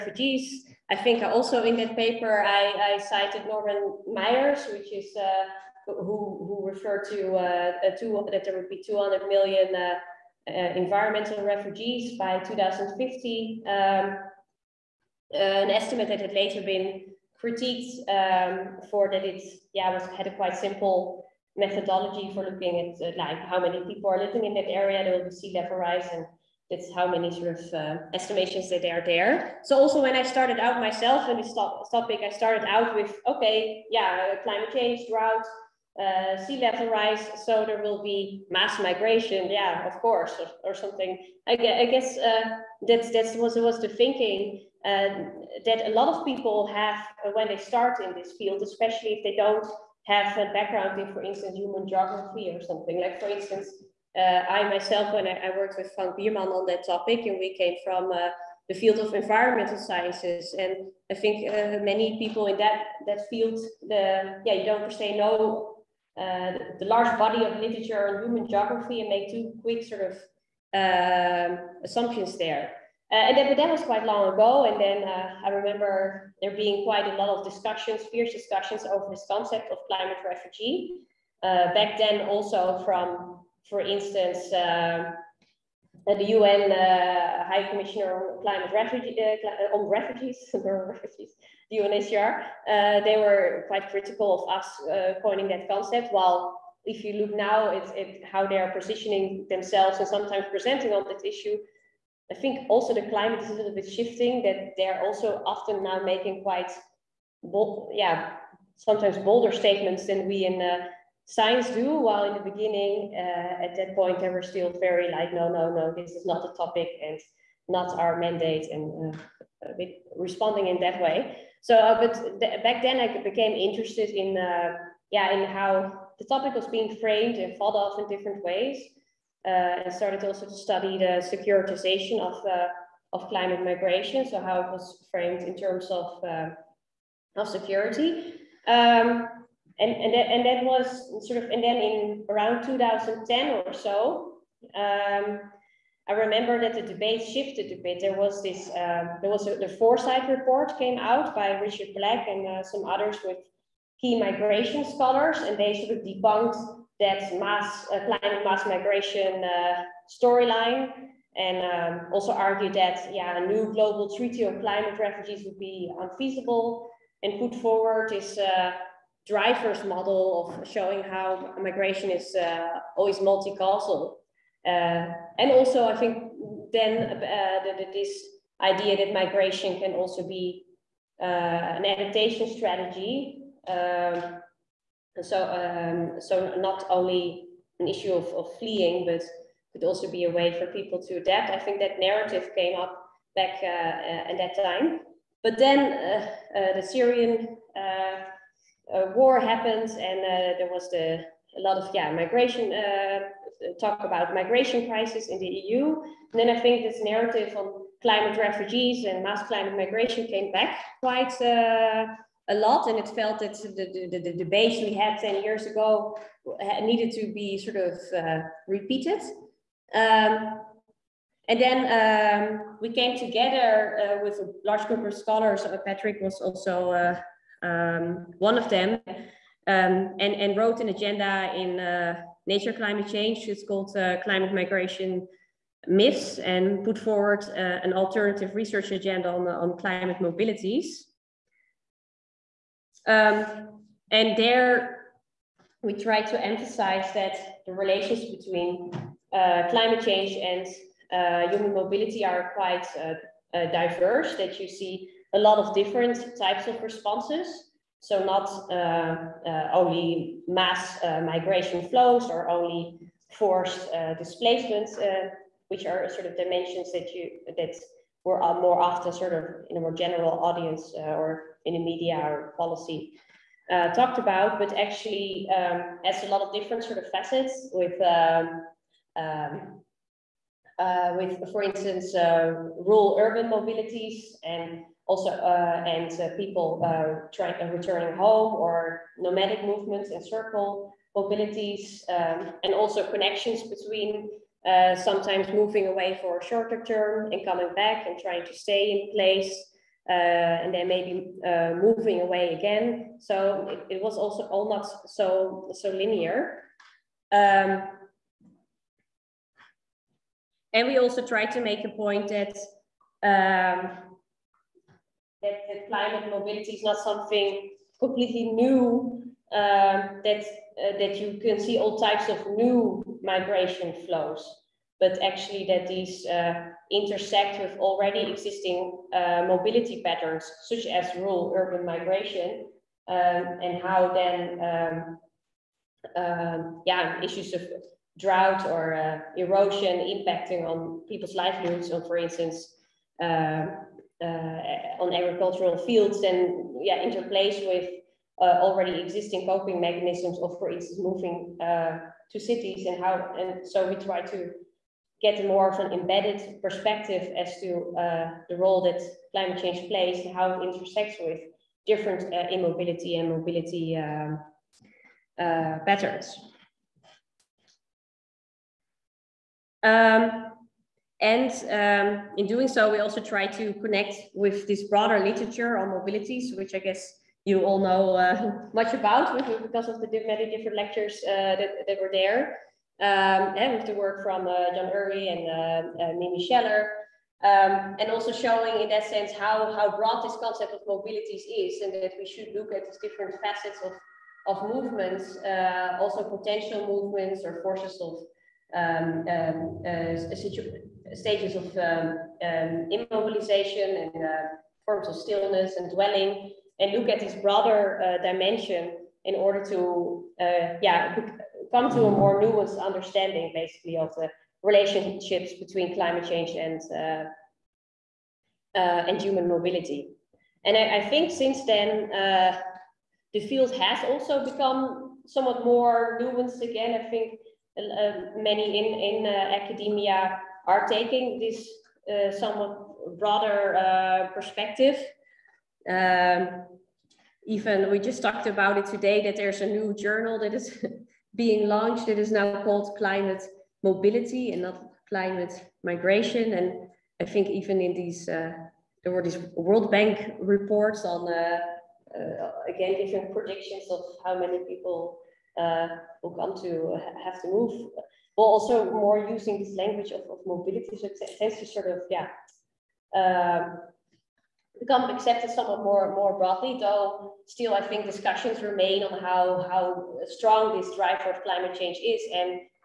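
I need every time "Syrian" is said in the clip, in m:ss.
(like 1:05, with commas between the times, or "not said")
3:16.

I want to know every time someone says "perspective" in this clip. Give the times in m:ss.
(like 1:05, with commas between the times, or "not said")
5:56, 7:14.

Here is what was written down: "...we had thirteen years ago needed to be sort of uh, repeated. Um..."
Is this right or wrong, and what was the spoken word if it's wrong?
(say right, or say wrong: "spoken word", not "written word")
wrong: "ten", not "thirteen".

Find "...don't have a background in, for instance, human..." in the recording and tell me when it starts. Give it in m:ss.
0:49.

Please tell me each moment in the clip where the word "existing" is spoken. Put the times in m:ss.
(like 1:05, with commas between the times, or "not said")
5:28, 5:48.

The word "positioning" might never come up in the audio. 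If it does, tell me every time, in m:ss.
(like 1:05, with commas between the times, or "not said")
1:38.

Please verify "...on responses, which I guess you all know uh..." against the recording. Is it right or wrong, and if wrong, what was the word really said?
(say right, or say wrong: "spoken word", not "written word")
wrong: "mobilities", not "responses".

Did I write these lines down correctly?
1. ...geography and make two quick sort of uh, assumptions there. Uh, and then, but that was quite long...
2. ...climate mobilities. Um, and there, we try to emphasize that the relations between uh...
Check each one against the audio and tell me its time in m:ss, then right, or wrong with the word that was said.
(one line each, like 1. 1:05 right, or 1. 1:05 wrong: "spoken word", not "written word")
1. 1:08 right
2. 3:59 right.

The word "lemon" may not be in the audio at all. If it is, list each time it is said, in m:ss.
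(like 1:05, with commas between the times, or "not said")
not said.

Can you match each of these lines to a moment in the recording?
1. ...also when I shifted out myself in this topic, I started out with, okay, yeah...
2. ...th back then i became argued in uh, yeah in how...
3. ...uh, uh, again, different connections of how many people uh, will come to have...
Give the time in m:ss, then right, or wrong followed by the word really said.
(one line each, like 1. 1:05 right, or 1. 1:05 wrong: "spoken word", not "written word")
1. 0:29 wrong: "started", not "shifted"
2. 2:02 wrong: "interested", not "argued"
3. 7:31 wrong: "predictions", not "connections".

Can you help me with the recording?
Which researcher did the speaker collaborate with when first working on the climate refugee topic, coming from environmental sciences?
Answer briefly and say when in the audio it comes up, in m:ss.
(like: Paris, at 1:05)
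Frank Biermann, at 0:55.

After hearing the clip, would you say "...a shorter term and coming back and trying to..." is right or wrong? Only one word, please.
right.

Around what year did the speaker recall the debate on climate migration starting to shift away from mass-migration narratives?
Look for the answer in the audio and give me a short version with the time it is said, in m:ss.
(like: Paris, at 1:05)
2010, at 2:22.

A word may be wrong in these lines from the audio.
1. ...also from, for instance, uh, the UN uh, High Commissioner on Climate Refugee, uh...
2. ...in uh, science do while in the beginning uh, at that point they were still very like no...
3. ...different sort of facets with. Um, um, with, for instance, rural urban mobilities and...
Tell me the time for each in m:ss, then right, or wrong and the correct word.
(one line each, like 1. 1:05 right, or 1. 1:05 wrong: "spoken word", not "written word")
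1. 1:22 right
2. 1:50 right
3. 4:36 right.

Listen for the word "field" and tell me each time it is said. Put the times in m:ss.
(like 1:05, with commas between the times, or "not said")
0:48, 0:58, 1:03, 5:45, 7:03.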